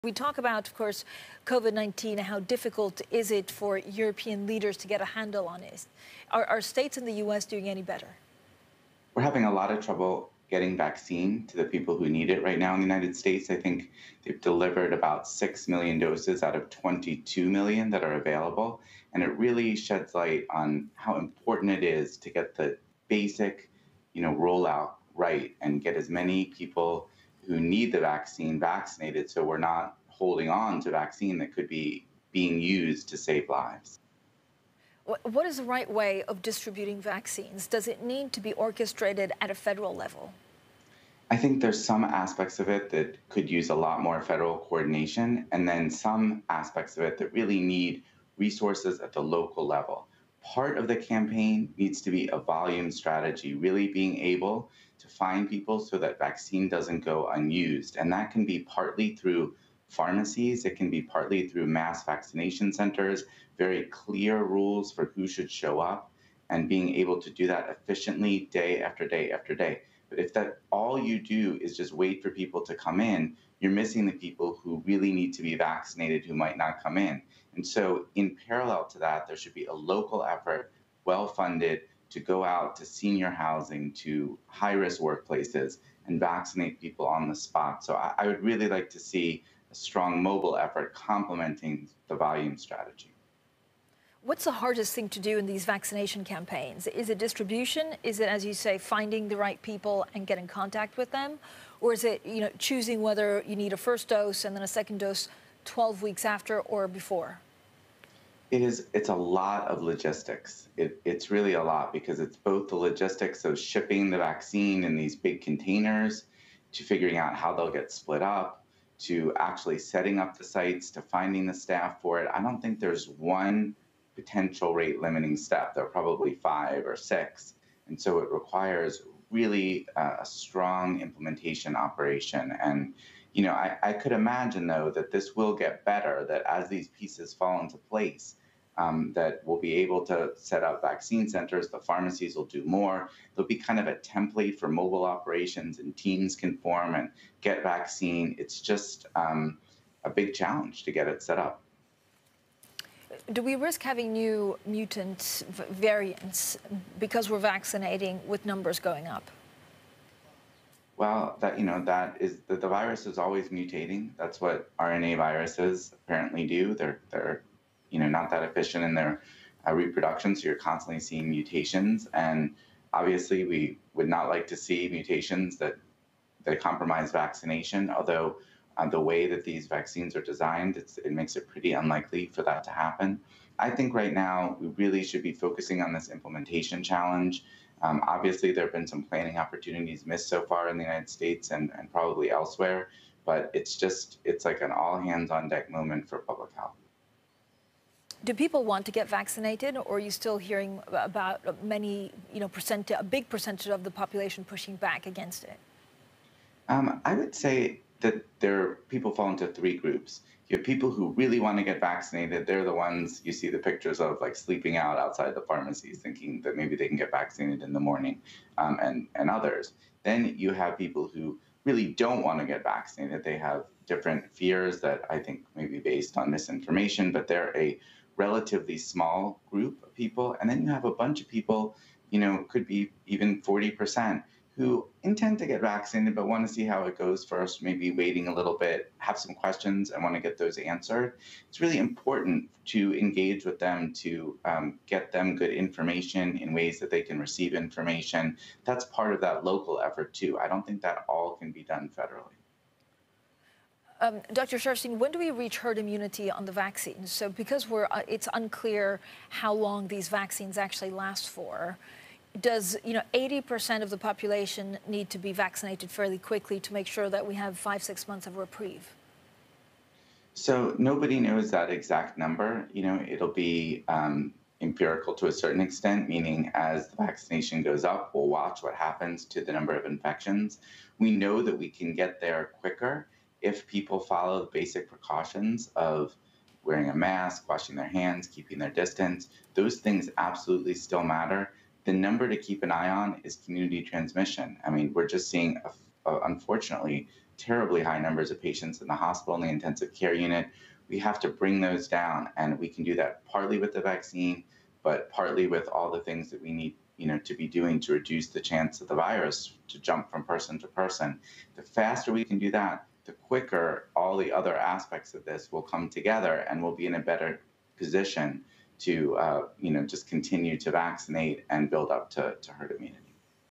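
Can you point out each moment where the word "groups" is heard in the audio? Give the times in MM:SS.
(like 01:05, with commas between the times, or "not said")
03:29, 03:49.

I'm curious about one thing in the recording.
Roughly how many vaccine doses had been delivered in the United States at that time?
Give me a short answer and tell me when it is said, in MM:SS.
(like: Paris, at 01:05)
6 million, at 00:15.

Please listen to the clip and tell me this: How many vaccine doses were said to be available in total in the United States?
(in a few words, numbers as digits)
22 million.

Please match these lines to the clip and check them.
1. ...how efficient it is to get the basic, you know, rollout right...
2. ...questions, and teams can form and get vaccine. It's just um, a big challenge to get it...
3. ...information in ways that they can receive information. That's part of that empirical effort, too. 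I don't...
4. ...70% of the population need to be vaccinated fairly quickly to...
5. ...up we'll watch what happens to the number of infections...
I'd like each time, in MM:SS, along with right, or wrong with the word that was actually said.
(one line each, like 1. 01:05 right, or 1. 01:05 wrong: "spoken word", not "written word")
1. 00:20 wrong: "important", not "efficient"
2. 02:25 wrong: "operations", not "questions"
3. 04:05 wrong: "local", not "empirical"
4. 04:23 wrong: "80", not "70"
5. 04:37 right.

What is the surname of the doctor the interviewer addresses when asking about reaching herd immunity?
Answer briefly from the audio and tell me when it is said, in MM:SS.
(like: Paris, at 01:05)
Sharfstein, at 04:14.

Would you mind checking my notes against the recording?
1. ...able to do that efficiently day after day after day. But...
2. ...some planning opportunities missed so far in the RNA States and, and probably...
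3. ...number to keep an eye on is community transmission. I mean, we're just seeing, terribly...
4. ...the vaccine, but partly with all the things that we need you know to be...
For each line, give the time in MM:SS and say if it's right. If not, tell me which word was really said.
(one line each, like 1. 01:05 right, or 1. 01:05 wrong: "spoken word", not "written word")
1. 01:06 right
2. 03:08 wrong: "United", not "RNA"
3. 04:51 wrong: "unfortunately", not "terribly"
4. 05:03 right.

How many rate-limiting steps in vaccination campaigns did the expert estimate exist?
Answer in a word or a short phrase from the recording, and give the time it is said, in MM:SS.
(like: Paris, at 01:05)
5 or 6, at 02:06.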